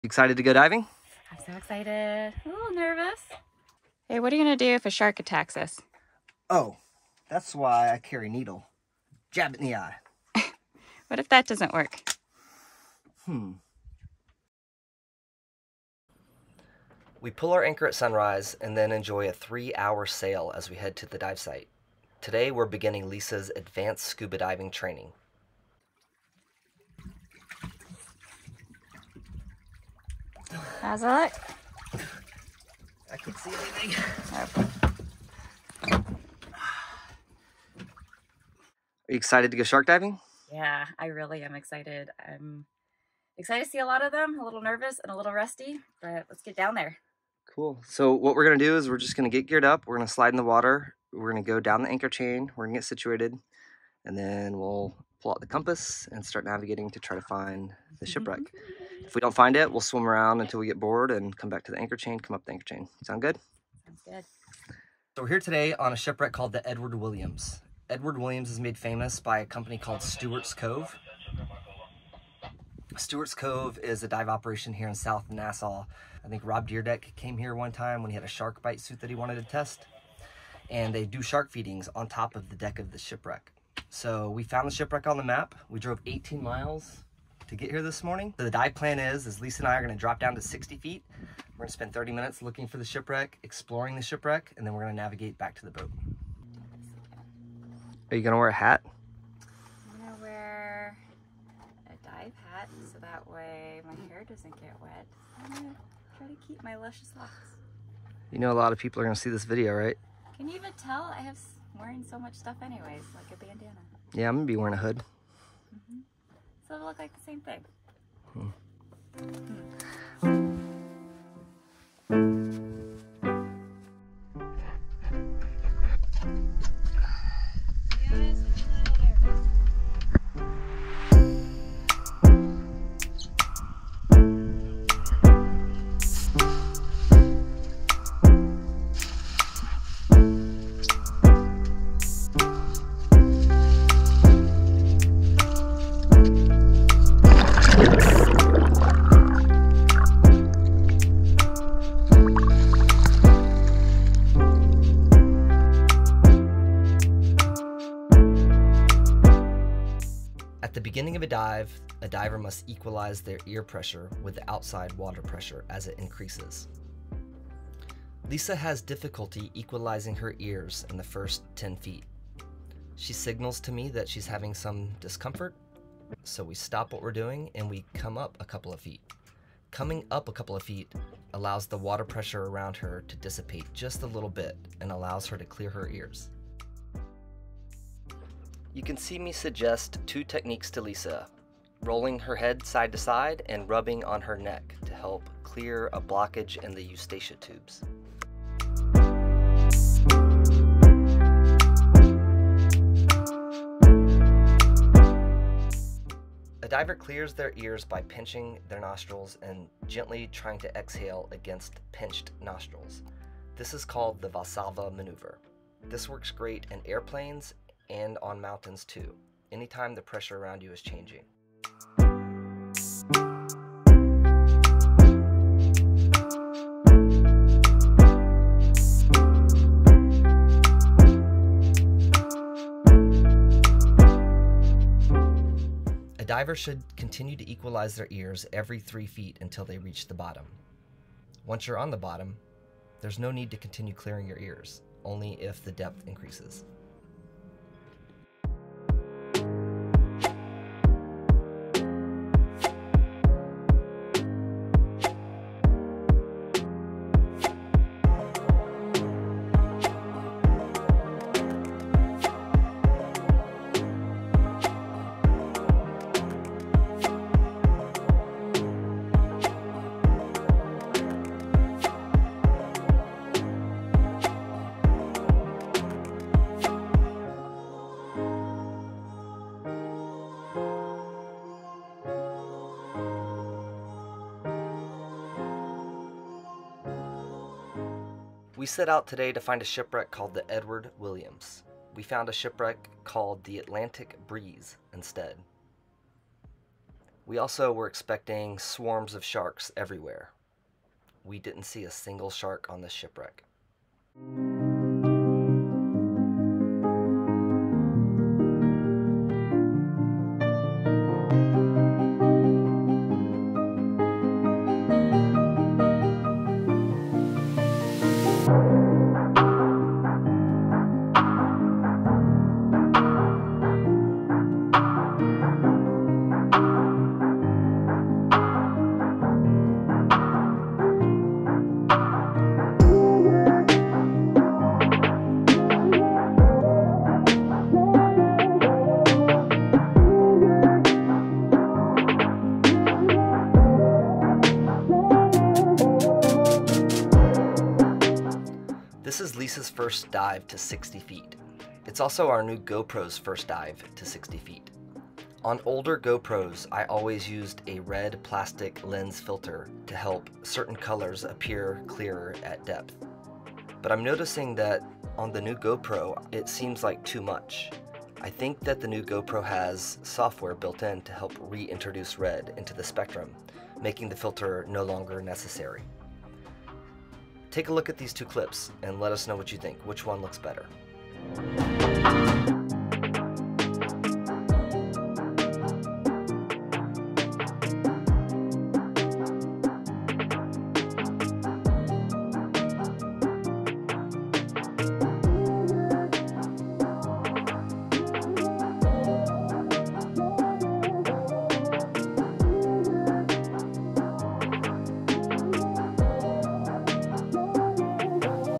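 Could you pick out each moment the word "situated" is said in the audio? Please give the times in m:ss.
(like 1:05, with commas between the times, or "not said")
0:52.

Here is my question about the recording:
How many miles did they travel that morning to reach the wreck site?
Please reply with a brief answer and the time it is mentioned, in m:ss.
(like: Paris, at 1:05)
18 miles, at 1:26.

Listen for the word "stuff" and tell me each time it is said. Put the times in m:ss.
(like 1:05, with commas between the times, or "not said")
1:52.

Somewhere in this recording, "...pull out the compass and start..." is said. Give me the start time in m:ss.
0:55.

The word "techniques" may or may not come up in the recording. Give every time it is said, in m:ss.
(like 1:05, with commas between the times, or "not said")
3:10.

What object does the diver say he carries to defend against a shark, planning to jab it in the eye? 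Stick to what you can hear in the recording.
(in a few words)
Needle.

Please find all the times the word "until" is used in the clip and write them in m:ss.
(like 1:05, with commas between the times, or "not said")
1:00, 3:59.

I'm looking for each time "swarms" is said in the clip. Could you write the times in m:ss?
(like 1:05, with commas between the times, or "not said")
4:58.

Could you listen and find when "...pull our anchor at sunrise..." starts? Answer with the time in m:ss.
0:17.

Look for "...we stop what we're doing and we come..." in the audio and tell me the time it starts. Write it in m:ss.
2:56.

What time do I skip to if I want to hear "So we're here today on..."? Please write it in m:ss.
1:05.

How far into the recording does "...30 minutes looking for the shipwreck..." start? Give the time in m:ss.
1:31.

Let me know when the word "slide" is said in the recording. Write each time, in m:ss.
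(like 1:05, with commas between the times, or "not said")
0:50.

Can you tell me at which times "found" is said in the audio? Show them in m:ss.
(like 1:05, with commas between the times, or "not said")
1:24, 4:52.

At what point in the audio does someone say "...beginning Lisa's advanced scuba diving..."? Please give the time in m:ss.
0:22.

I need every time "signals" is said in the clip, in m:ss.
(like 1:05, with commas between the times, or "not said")
2:53.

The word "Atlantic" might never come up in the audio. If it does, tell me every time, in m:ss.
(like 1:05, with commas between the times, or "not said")
4:53.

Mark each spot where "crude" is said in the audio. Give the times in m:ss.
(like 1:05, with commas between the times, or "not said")
not said.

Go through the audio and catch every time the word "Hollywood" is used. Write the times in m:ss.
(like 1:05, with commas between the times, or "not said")
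not said.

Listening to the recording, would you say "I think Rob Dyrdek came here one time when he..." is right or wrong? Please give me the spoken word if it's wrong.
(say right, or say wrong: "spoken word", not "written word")
right.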